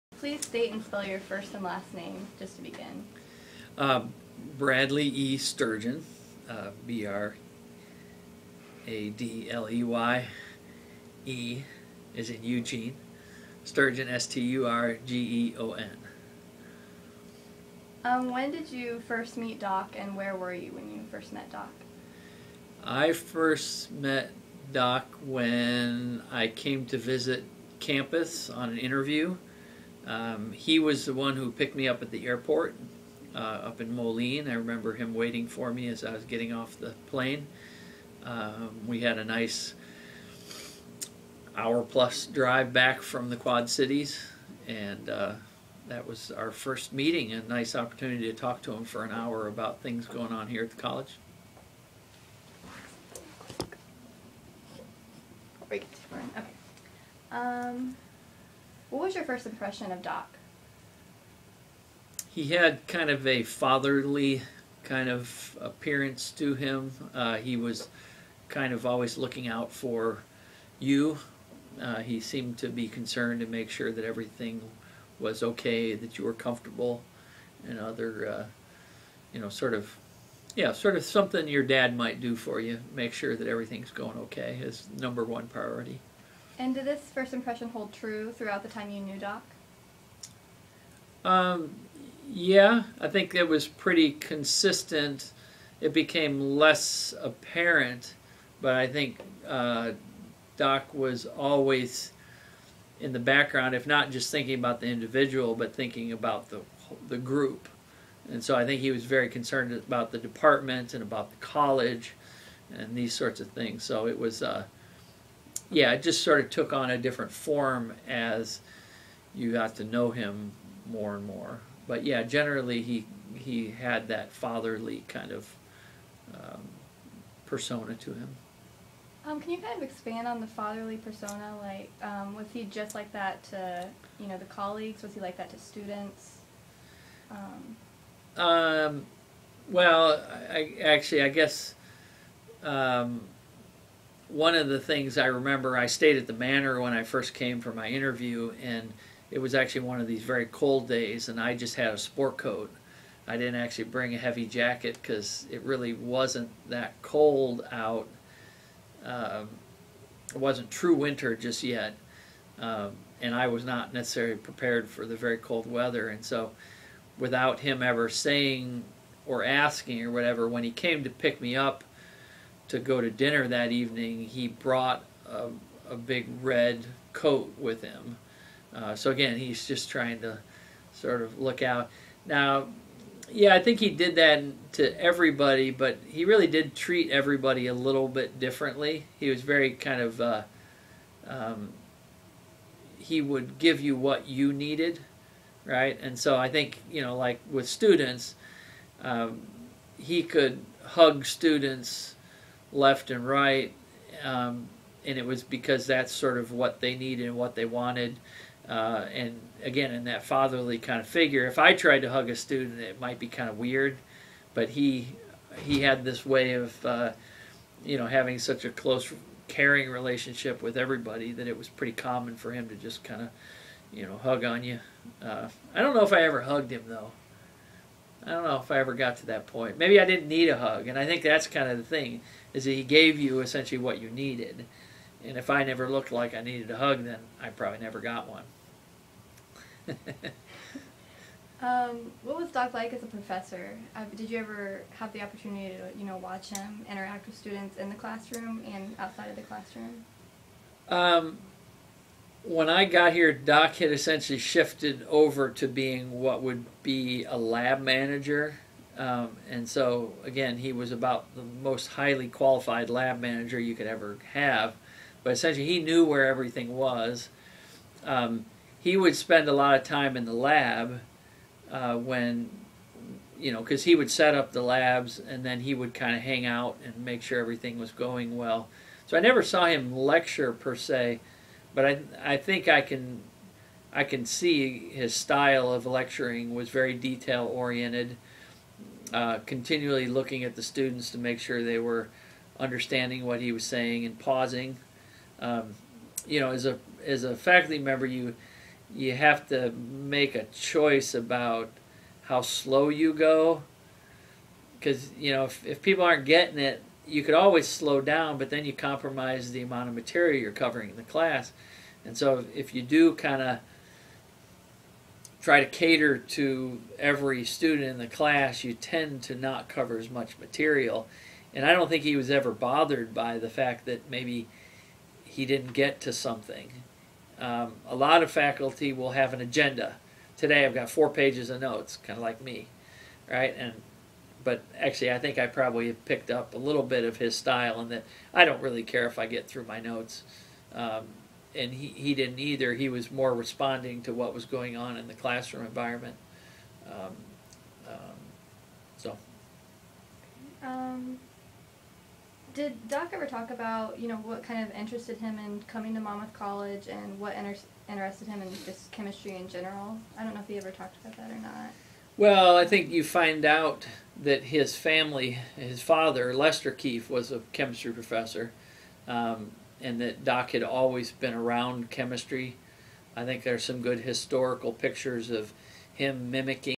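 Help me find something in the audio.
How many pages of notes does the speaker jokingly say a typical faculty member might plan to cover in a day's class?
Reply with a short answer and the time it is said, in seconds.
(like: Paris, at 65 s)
4, at 330 s.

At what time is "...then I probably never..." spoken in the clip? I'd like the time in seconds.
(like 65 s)
237 s.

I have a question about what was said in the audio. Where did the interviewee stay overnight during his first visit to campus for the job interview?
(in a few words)
the manor.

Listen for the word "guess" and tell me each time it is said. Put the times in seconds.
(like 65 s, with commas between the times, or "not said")
141 s.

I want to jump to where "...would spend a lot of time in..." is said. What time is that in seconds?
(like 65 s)
268 s.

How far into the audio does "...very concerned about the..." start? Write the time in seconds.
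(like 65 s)
109 s.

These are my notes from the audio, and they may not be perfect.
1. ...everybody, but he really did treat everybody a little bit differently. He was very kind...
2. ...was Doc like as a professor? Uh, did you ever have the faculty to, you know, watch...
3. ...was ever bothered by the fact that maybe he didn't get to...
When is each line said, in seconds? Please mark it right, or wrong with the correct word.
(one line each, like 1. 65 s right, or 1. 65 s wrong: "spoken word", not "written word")
1. 185 s right
2. 242 s wrong: "opportunity", not "faculty"
3. 322 s right.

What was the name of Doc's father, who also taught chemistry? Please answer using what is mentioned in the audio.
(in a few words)
Lester Kieft.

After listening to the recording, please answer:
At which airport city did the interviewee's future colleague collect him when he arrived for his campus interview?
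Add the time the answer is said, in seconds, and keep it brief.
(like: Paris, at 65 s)
Moline, at 33 s.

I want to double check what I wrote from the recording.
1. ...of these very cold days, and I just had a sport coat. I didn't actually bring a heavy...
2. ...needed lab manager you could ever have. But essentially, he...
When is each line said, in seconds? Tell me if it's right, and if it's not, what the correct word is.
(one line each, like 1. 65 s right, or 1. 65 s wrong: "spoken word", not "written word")
1. 149 s right
2. 262 s wrong: "qualified", not "needed".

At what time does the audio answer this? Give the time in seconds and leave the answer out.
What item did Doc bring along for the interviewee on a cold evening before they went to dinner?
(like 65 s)
175 s.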